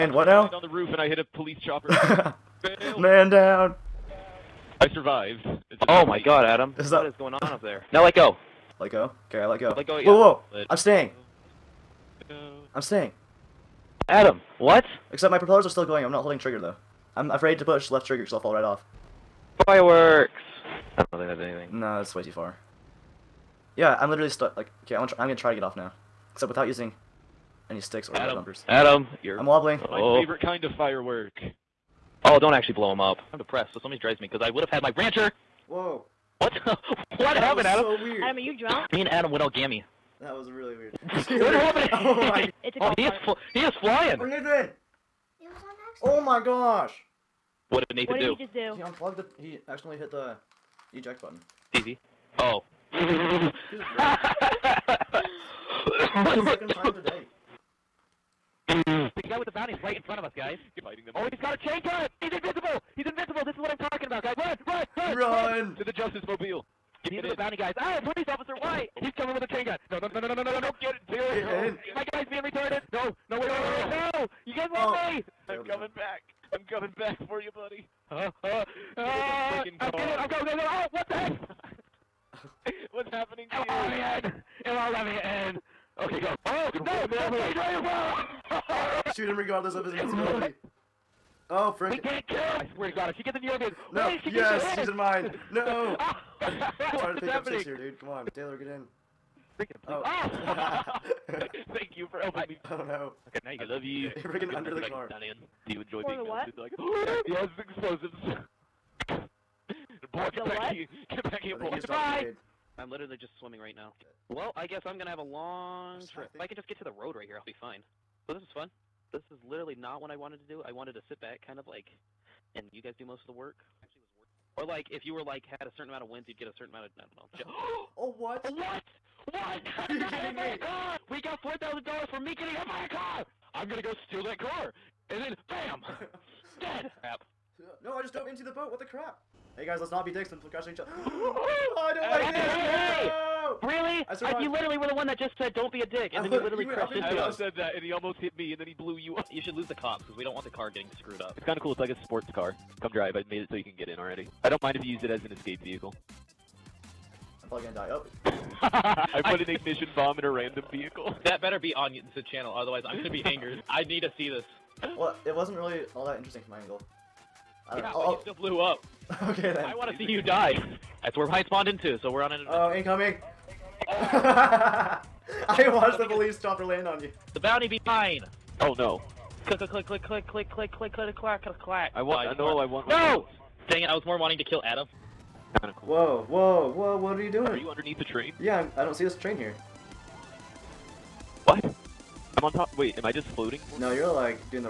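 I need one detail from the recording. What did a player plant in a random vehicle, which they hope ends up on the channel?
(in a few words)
ignition bomb.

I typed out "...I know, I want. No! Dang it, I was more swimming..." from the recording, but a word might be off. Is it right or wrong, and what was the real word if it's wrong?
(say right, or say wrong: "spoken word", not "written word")
wrong: "wanting", not "swimming".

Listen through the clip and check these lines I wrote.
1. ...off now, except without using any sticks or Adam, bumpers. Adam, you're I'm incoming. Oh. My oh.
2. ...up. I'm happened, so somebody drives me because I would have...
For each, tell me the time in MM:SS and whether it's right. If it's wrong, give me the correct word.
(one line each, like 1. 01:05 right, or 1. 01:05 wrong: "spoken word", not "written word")
1. 00:25 wrong: "wobbling", not "incoming"
2. 00:32 wrong: "depressed", not "happened".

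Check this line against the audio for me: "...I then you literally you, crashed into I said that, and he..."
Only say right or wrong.
right.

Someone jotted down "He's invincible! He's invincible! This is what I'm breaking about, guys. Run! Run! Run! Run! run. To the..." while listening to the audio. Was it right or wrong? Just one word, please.
wrong.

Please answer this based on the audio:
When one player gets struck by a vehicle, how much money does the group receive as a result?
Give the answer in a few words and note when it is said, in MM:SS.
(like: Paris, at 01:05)
$4,000, at 02:11.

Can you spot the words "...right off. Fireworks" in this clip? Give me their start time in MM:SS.
00:18.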